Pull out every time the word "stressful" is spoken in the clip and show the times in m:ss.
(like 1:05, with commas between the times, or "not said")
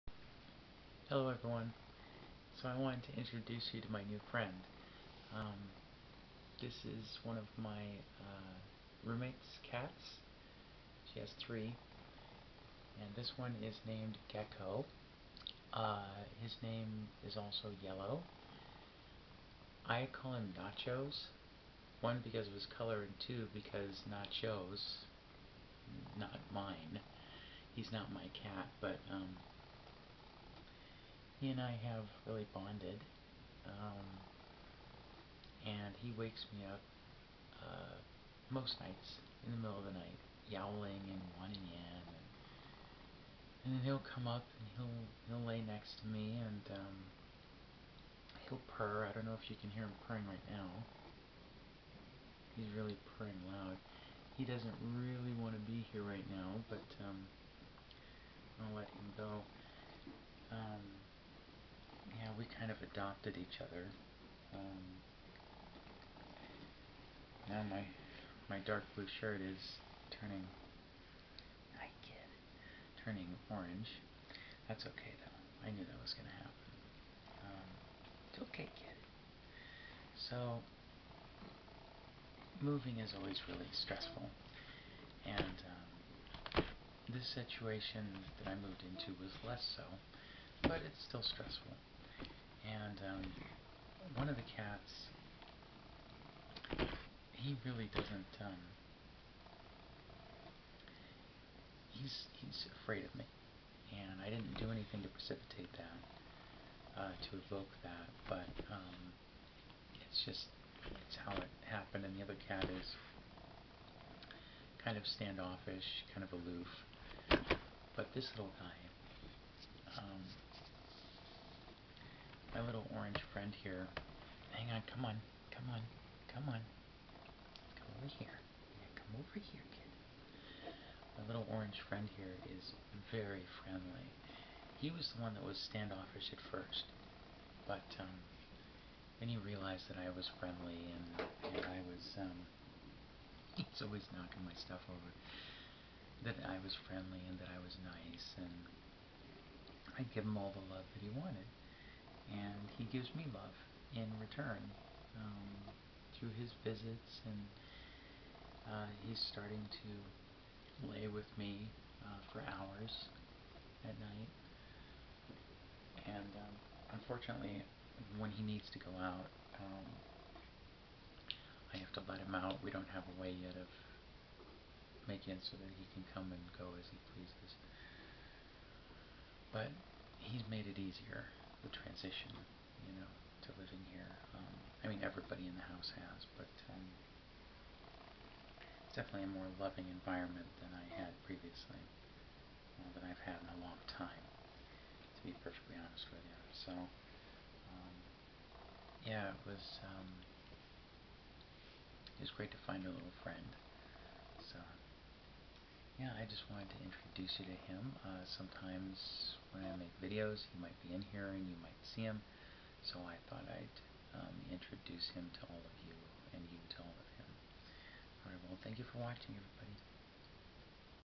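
1:23, 1:31.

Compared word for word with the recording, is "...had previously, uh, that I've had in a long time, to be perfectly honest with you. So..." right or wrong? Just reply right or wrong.
right.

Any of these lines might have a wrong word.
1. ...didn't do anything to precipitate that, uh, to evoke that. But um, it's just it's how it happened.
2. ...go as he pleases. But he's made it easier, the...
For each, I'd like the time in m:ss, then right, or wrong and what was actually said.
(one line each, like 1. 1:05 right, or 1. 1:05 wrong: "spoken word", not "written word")
1. 1:44 right
2. 2:56 right.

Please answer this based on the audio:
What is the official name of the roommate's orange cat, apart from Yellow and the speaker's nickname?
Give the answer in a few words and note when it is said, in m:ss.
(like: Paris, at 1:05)
Gecko, at 0:14.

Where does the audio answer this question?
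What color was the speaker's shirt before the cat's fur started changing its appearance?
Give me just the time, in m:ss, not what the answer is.
1:08.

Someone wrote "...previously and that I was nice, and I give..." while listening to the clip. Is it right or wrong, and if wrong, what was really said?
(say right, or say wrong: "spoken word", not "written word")
wrong: "friendly", not "previously".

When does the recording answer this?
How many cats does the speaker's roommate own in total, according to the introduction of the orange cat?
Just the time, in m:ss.
0:11.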